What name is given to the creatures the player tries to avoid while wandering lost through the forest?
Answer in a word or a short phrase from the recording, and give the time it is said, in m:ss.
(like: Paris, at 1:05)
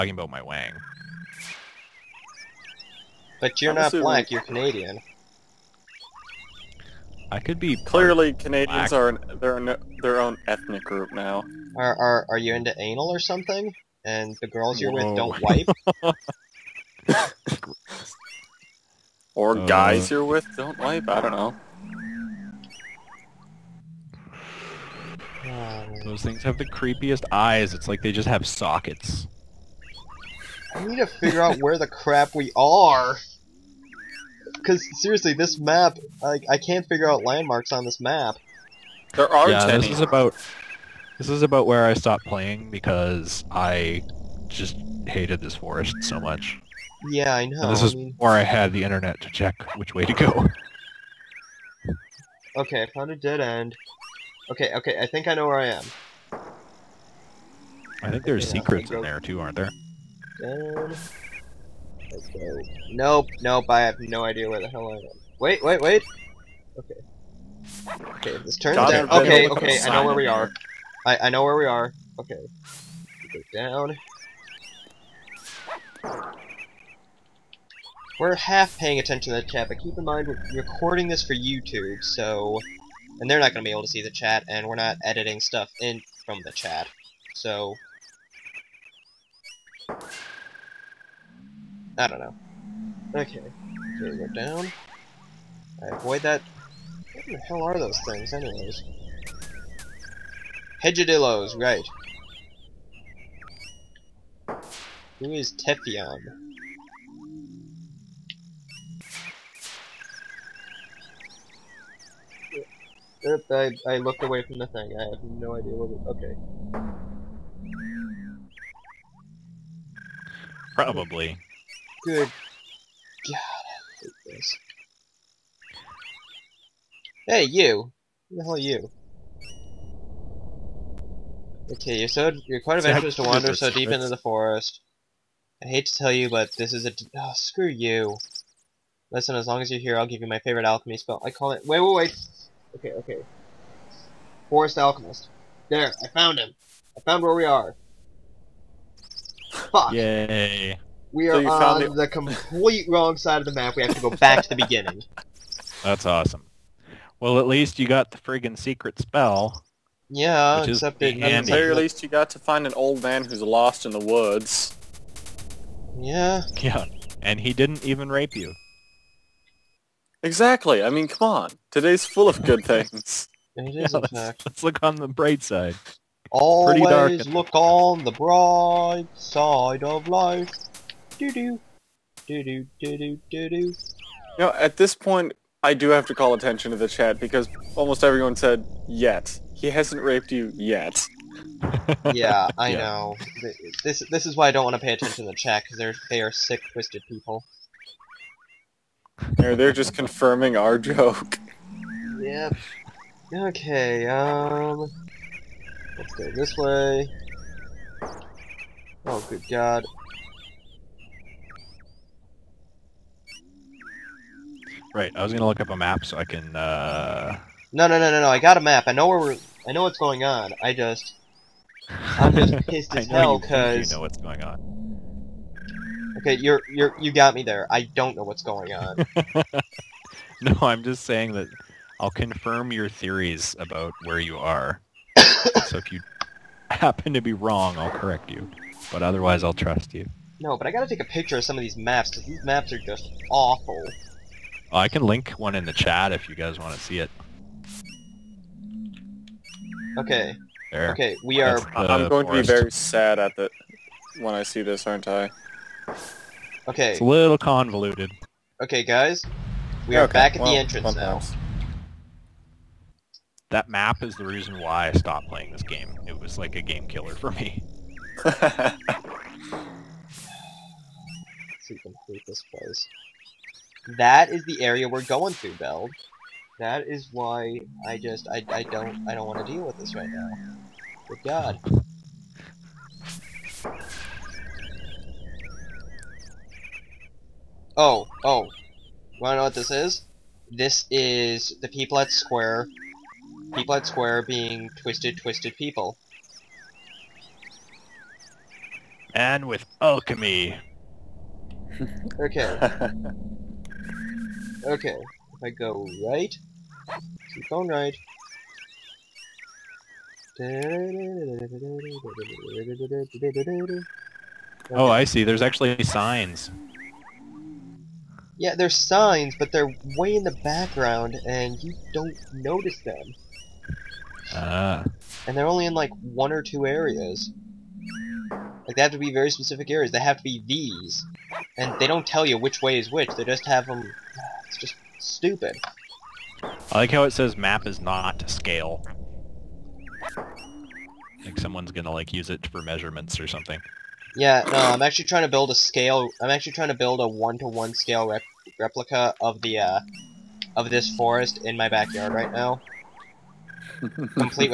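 Hedgadillos, at 1:40.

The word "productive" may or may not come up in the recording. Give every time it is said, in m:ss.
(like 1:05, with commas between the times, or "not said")
not said.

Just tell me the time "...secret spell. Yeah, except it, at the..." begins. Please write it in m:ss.
2:38.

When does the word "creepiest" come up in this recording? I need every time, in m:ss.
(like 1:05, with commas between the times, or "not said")
0:26.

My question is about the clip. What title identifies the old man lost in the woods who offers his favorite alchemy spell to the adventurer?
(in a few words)
Forest Alchemist.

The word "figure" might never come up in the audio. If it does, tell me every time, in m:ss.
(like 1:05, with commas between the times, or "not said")
0:31, 0:36.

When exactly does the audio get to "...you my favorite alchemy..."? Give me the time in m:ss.
2:20.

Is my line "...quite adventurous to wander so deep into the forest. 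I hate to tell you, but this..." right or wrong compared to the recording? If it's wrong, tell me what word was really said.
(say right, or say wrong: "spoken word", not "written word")
right.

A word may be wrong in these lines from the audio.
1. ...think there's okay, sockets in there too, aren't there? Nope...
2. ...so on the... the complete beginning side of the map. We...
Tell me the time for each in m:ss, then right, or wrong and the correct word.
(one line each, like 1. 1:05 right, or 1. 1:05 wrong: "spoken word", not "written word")
1. 0:58 wrong: "secrets", not "sockets"
2. 2:31 wrong: "wrong", not "beginning".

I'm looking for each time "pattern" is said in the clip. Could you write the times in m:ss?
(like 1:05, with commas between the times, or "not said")
not said.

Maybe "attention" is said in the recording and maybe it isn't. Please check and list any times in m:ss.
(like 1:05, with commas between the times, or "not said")
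1:18, 3:06, 3:14.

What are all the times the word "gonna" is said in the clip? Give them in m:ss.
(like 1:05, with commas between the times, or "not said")
3:35, 5:41.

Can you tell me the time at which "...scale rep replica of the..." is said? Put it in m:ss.
5:47.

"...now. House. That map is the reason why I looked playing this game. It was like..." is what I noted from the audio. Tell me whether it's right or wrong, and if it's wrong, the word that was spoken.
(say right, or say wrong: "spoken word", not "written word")
wrong: "stopped", not "looked".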